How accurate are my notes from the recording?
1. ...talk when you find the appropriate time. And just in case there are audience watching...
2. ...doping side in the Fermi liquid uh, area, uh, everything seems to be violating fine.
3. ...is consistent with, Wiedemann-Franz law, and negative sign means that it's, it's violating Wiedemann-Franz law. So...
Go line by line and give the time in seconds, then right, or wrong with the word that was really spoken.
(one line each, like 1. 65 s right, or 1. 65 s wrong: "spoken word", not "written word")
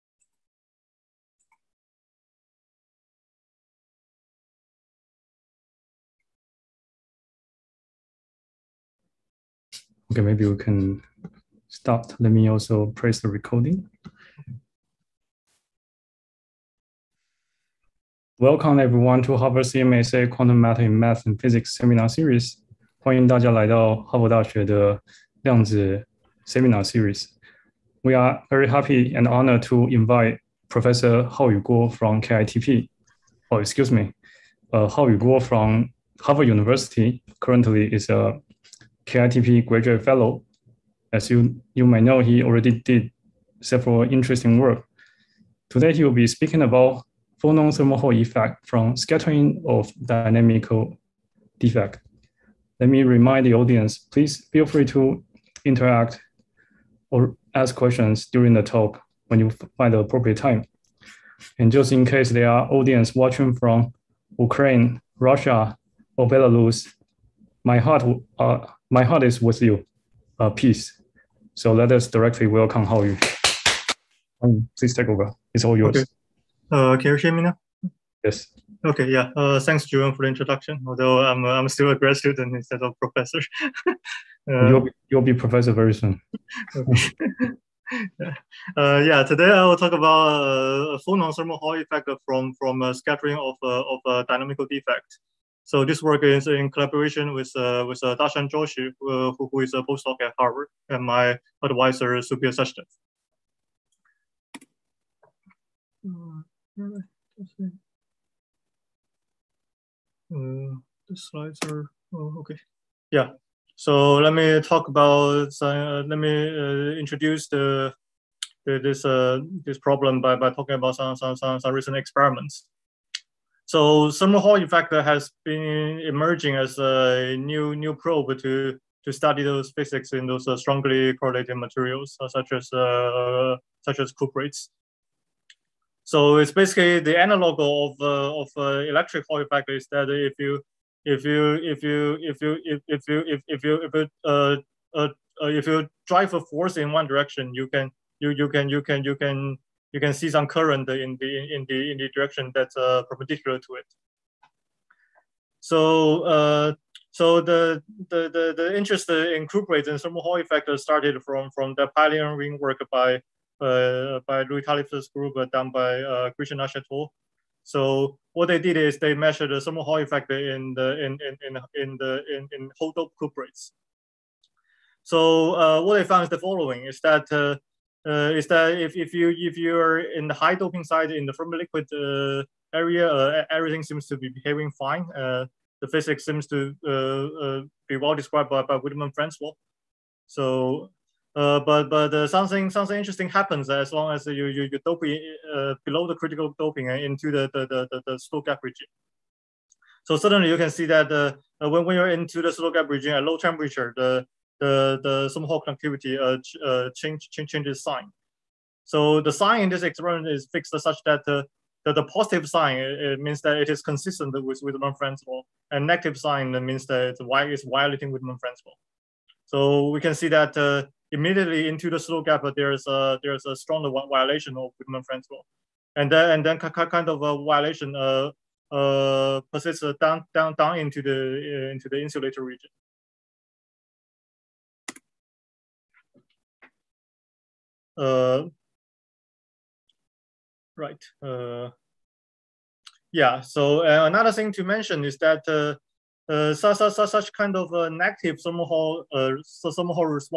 1. 58 s right
2. 180 s wrong: "behaving", not "violating"
3. 213 s right.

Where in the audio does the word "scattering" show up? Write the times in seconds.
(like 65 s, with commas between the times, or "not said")
48 s, 92 s.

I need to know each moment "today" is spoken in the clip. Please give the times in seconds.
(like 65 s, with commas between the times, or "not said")
45 s, 89 s.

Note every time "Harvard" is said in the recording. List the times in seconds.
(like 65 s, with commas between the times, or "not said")
19 s, 36 s, 100 s.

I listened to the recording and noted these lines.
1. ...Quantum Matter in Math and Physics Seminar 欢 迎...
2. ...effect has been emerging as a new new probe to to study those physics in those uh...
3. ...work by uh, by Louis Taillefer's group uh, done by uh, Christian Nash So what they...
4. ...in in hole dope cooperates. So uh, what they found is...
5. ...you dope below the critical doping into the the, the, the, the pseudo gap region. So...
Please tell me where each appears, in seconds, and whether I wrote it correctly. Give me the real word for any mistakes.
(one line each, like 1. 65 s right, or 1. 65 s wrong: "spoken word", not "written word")
1. 20 s right
2. 124 s right
3. 162 s right
4. 172 s wrong: "cuprates", not "cooperates"
5. 194 s right.